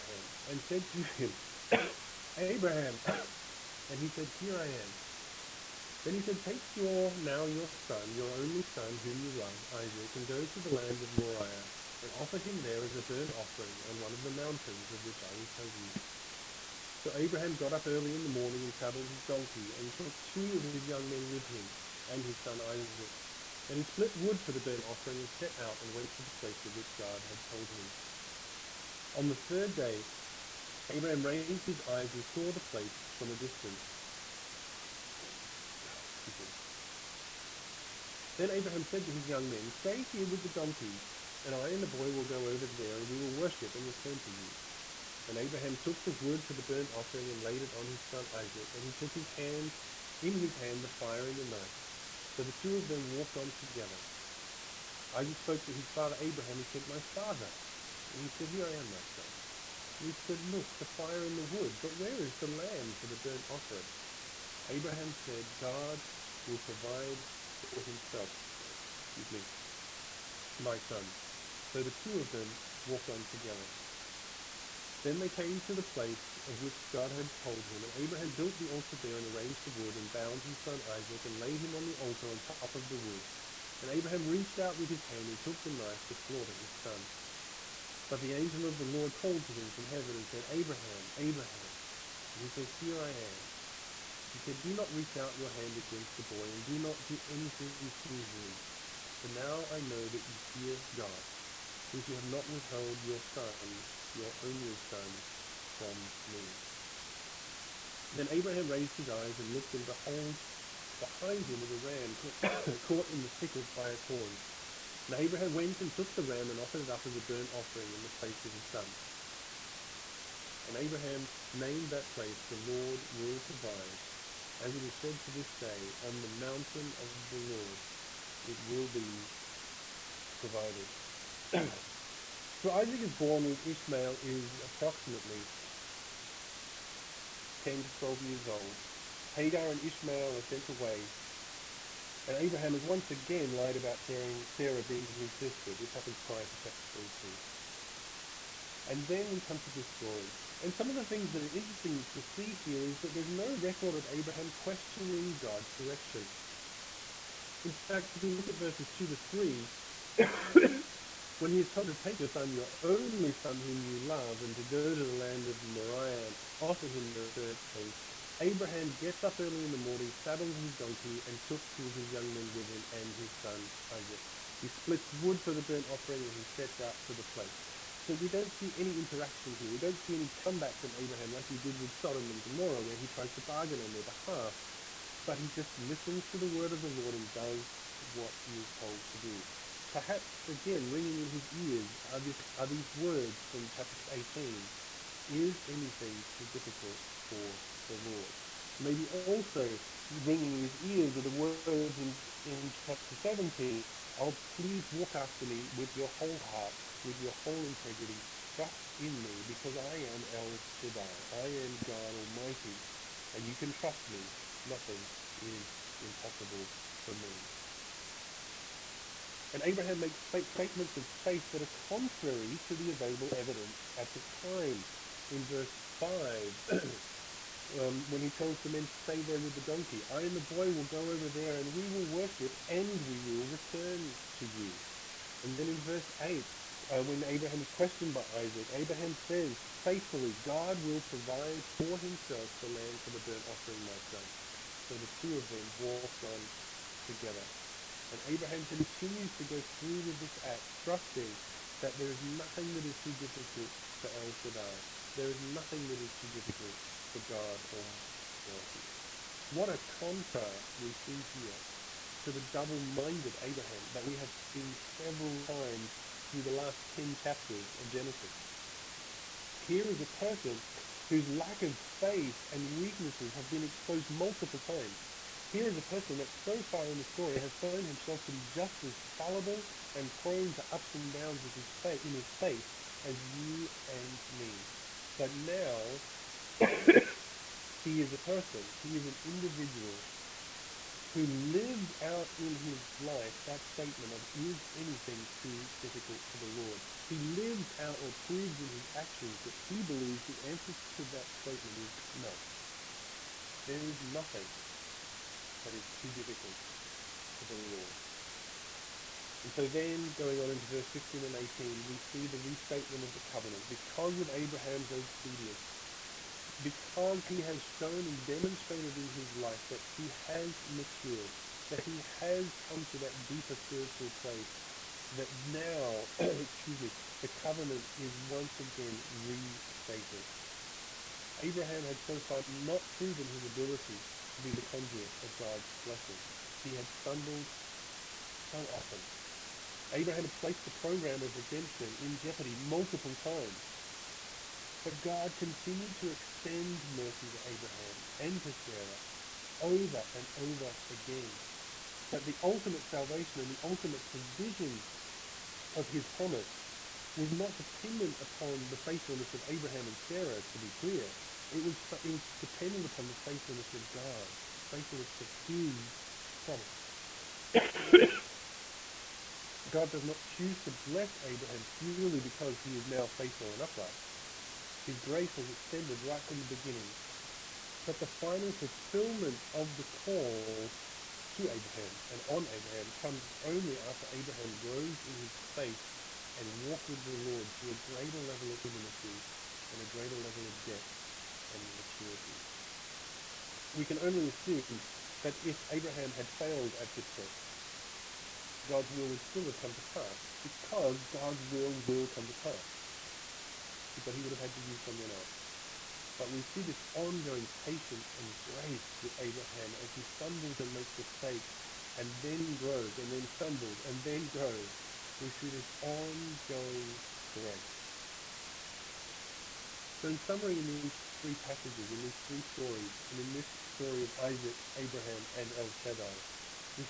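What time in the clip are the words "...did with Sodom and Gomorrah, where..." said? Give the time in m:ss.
3:01.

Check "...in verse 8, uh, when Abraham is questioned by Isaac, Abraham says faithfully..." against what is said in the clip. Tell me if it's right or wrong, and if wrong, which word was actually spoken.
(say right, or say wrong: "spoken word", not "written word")
right.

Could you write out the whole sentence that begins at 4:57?
He lives out or proves in his actions that he believes the answer to that statement is no.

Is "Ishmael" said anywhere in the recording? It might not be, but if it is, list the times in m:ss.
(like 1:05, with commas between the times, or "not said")
2:13, 2:19.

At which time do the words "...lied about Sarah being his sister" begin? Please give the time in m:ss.
2:23.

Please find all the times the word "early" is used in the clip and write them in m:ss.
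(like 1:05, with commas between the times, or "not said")
0:17, 2:49.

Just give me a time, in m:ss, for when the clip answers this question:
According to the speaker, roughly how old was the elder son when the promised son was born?
2:14.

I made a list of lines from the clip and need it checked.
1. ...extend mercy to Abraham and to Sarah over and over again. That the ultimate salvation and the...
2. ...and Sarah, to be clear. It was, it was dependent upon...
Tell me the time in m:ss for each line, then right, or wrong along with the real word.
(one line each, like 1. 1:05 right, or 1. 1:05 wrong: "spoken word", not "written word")
1. 5:46 right
2. 5:59 right.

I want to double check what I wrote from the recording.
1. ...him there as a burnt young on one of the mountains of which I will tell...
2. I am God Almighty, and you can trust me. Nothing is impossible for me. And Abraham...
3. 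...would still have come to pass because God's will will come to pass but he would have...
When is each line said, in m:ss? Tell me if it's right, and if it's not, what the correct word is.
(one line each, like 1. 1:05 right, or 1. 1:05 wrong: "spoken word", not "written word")
1. 0:12 wrong: "offering", not "young"
2. 3:31 right
3. 6:39 right.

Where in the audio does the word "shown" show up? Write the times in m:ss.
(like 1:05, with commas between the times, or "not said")
4:37, 5:17.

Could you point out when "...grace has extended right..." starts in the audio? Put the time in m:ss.
6:14.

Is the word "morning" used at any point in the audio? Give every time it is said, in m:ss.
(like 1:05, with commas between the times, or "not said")
0:18, 2:49.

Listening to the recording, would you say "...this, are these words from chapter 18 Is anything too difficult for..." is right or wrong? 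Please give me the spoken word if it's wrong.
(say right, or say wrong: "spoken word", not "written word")
right.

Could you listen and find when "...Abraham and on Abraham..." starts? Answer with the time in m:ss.
6:21.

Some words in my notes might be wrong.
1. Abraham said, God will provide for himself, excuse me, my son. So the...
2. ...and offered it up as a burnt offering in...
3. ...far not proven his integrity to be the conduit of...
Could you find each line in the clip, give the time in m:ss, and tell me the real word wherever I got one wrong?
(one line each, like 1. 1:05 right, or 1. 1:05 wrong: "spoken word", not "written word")
1. 1:04 right
2. 1:56 right
3. 5:32 wrong: "ability", not "integrity".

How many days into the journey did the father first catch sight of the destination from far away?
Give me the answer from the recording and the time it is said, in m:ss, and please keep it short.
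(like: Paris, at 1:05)
3, at 0:29.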